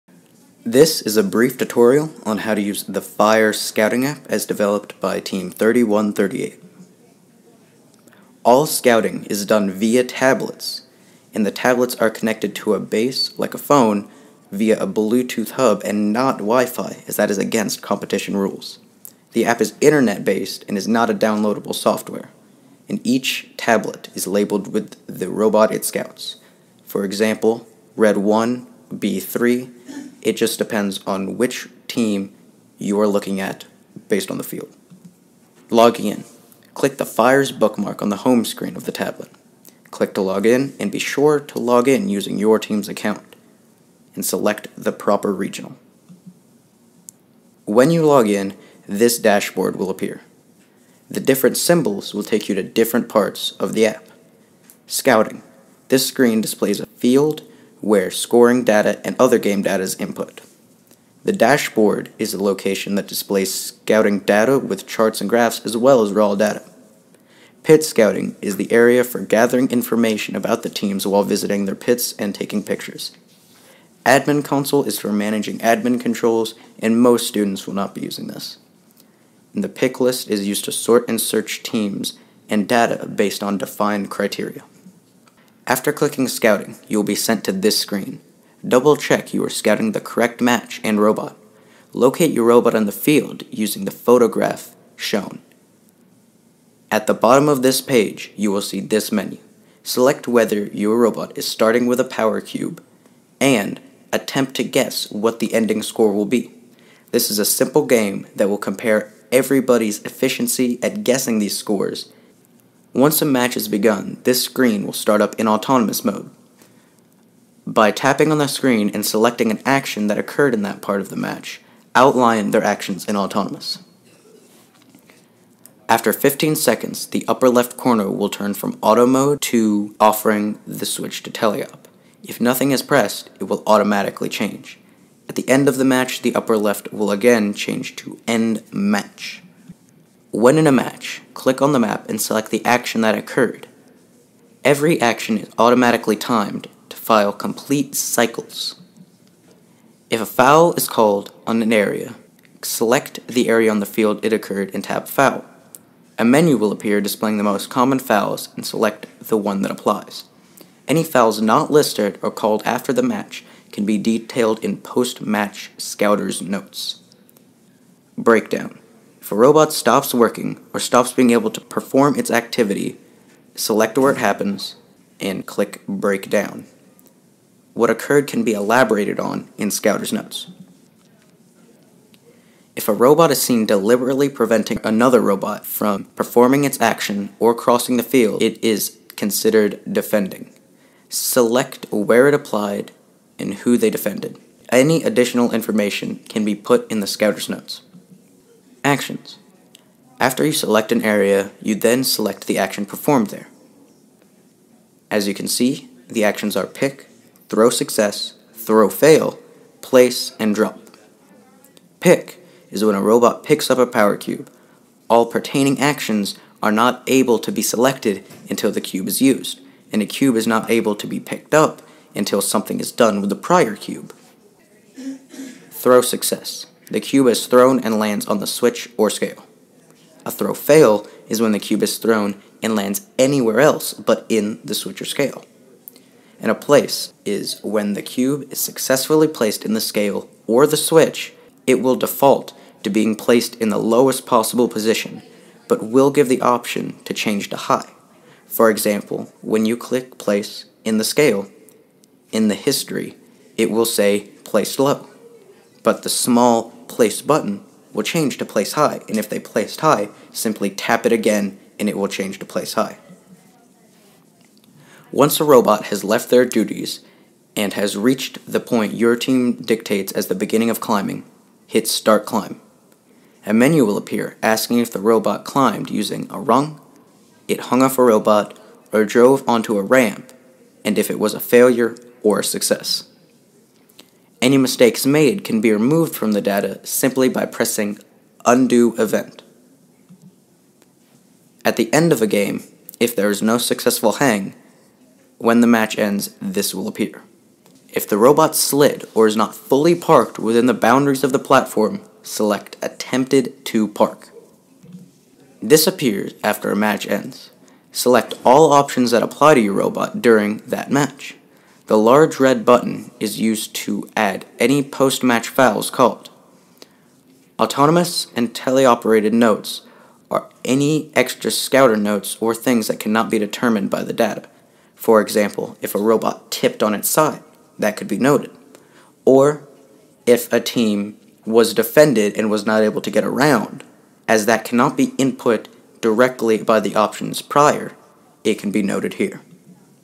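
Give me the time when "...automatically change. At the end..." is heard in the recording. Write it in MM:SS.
02:13.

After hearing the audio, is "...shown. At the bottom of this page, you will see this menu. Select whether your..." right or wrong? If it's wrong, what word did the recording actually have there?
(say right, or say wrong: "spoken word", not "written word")
right.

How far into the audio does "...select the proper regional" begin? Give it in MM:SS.
00:44.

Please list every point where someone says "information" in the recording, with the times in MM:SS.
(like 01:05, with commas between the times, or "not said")
01:09, 03:15.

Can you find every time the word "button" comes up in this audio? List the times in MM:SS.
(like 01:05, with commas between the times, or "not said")
04:17, 05:12.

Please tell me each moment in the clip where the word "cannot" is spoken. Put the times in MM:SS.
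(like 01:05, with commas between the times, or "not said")
05:23, 05:34.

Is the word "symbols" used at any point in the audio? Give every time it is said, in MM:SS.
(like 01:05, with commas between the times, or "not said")
00:51.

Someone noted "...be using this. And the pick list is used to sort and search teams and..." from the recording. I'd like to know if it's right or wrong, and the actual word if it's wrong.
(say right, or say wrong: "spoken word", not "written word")
right.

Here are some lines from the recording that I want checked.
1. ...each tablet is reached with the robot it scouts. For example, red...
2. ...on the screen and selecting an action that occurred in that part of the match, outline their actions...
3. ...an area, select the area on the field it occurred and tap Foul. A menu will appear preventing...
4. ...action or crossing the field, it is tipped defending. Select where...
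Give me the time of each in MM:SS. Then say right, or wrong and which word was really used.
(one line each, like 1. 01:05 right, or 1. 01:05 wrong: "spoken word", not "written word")
1. 00:23 wrong: "labeled", not "reached"
2. 01:58 right
3. 02:31 wrong: "displaying", not "preventing"
4. 03:06 wrong: "considered", not "tipped".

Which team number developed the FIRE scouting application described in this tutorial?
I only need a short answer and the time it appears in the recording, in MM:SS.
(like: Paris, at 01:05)
3138, at 00:05.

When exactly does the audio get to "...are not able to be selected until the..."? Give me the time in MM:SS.
03:36.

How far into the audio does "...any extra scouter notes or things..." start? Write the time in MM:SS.
05:20.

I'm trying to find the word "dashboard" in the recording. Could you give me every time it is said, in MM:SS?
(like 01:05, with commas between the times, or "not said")
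00:49, 01:01.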